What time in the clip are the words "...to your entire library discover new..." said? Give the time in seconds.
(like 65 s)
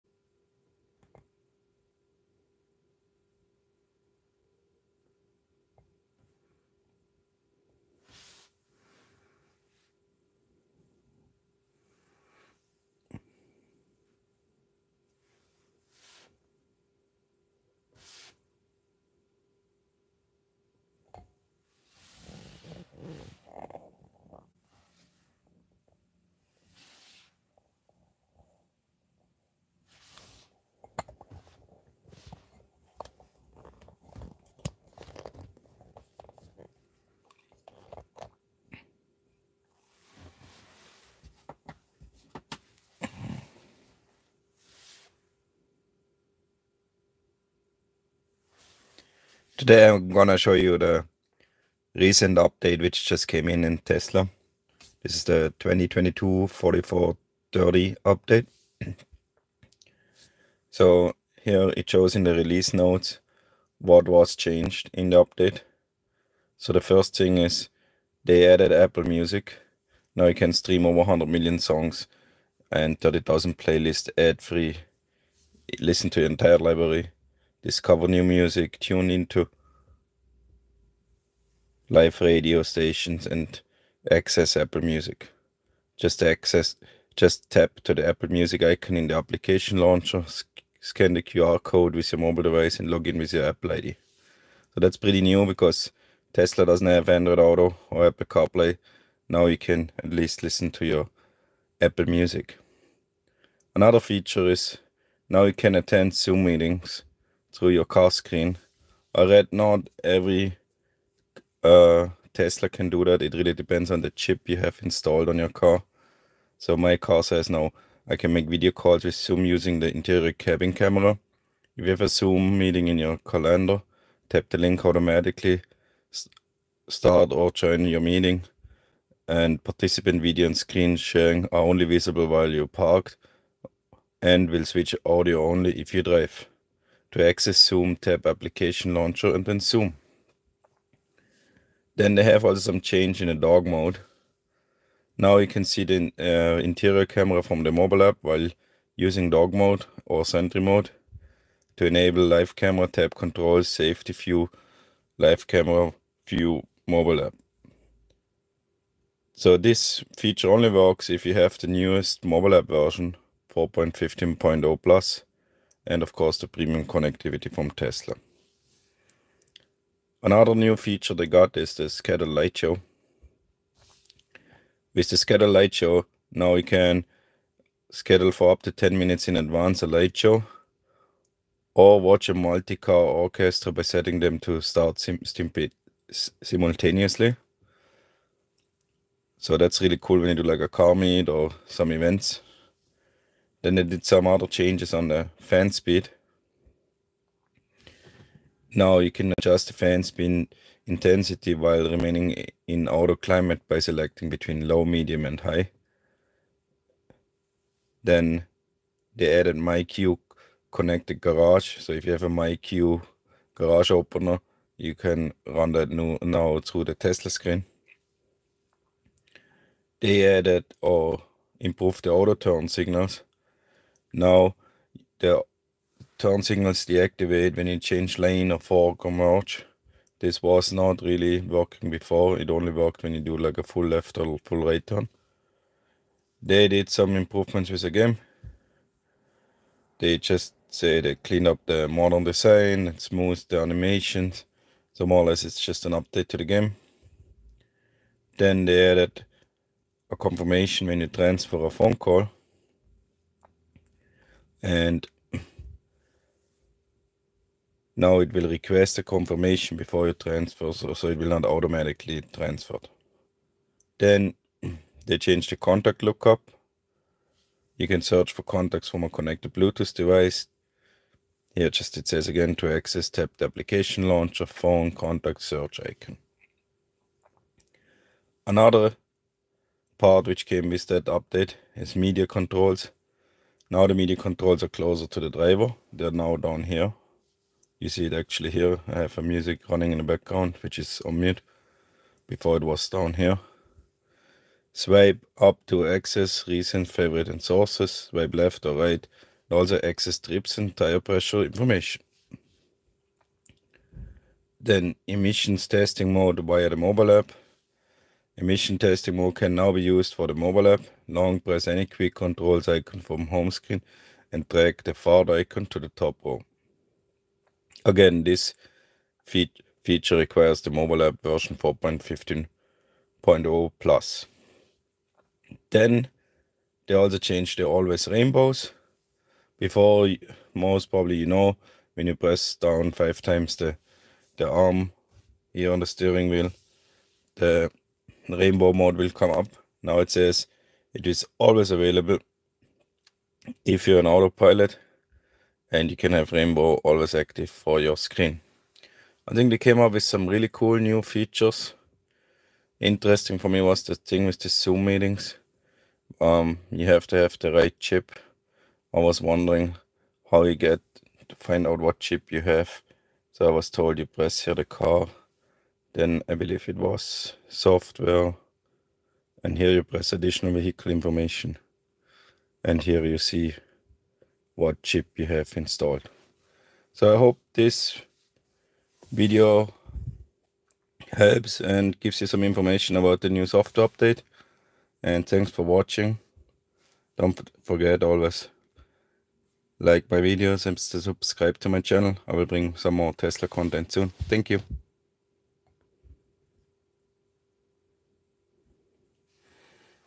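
76 s.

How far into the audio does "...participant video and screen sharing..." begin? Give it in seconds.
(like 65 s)
129 s.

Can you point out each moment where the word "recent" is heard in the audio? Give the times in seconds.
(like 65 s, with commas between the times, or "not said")
51 s, 296 s.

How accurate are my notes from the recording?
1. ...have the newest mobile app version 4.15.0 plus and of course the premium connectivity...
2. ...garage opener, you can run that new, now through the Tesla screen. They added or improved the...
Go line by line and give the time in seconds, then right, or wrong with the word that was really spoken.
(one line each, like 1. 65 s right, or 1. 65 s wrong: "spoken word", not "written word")
1. 161 s right
2. 213 s right.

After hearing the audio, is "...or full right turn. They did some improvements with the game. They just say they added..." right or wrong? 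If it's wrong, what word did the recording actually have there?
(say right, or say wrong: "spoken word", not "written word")
wrong: "cleaned", not "added".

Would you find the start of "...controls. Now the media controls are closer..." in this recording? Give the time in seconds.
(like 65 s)
282 s.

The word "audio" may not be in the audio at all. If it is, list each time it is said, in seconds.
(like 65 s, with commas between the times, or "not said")
135 s.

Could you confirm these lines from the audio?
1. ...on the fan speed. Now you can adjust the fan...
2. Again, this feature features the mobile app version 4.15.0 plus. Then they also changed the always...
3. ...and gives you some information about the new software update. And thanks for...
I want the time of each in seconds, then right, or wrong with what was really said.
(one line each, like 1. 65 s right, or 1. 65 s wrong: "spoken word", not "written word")
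1. 194 s right
2. 317 s wrong: "requires", not "features"
3. 381 s right.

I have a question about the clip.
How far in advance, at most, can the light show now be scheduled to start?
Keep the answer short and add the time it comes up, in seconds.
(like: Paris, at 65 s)
10 minutes, at 178 s.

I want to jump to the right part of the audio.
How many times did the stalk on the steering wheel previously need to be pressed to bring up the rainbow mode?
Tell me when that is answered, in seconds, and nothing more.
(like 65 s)
332 s.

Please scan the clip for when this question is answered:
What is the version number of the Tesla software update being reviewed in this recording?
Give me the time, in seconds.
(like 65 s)
55 s.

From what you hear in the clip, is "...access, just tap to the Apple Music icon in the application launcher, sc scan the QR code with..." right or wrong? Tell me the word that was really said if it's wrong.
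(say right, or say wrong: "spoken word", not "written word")
right.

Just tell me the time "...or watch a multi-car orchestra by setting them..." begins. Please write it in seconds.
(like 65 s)
181 s.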